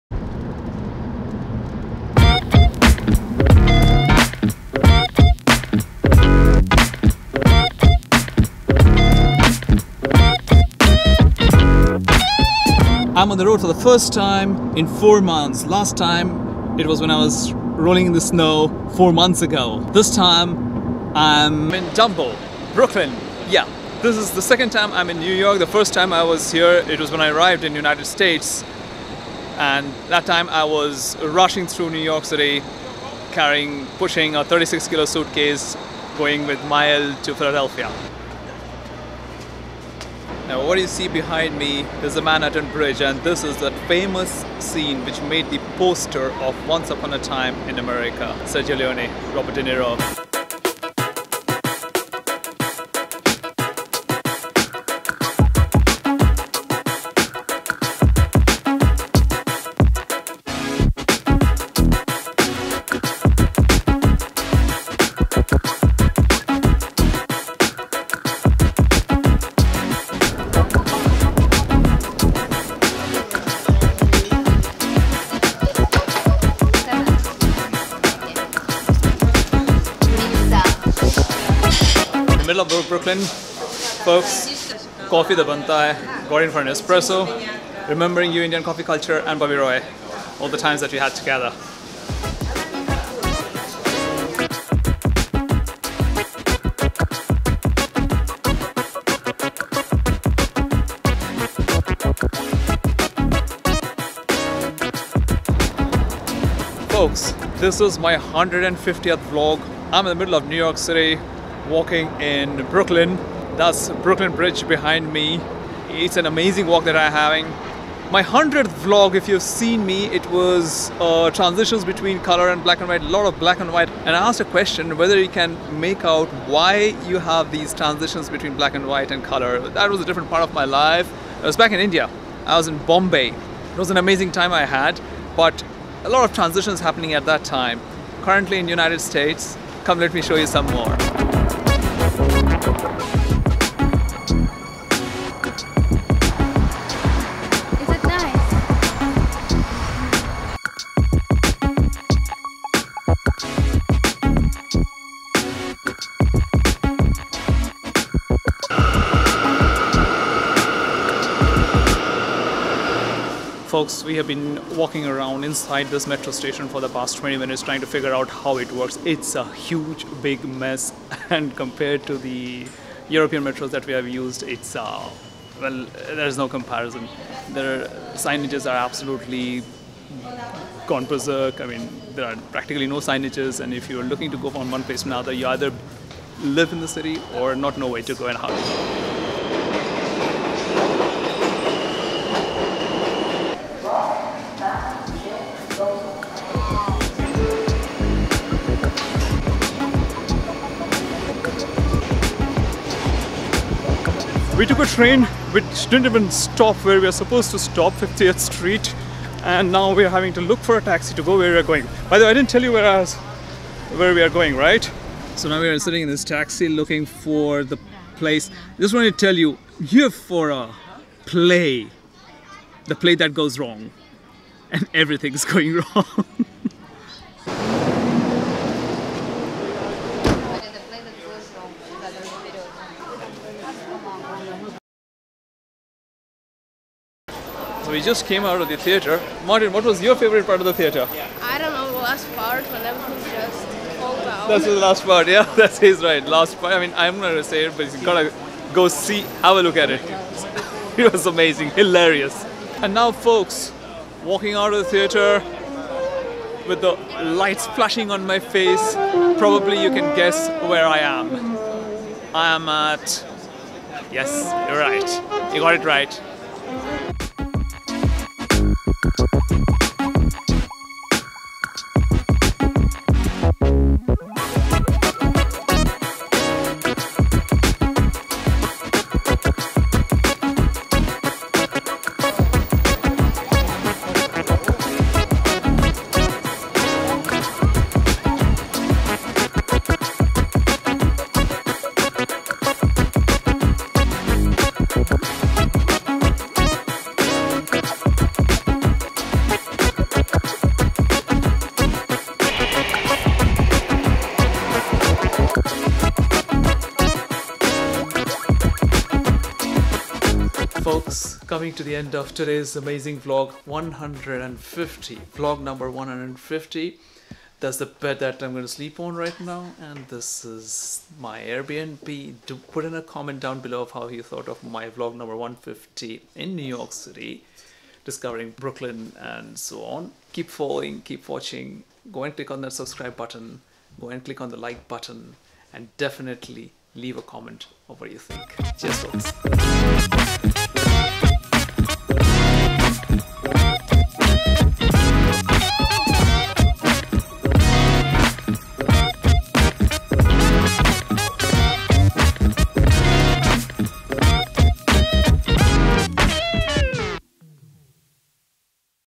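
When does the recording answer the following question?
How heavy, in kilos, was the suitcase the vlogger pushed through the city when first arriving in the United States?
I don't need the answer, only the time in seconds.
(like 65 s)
34 s.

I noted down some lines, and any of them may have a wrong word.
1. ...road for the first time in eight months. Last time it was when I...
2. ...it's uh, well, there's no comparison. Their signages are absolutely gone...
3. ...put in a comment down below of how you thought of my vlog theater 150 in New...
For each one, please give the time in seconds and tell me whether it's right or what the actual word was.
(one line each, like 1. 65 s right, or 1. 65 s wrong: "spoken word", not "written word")
1. 13 s wrong: "four", not "eight"
2. 174 s right
3. 322 s wrong: "number", not "theater".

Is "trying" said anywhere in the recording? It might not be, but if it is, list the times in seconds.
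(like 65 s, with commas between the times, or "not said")
167 s.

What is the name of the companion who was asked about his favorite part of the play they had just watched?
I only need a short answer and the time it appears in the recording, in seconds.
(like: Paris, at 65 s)
Martin, at 239 s.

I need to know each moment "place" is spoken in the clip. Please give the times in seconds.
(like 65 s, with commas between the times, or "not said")
184 s, 218 s.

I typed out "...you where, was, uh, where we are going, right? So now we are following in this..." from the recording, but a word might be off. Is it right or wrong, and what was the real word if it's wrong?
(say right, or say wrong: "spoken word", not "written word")
wrong: "sitting", not "following".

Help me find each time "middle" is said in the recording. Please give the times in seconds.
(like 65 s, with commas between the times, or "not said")
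82 s, 110 s.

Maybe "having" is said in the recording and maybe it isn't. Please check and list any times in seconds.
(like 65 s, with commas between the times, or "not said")
117 s, 210 s.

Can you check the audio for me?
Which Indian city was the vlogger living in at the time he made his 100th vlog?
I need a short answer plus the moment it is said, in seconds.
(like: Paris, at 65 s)
Bombay, at 132 s.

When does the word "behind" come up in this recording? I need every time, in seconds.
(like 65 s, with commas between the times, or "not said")
41 s, 114 s.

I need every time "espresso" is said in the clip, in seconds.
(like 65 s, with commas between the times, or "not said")
86 s.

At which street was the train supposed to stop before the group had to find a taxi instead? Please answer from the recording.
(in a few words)
50th Street.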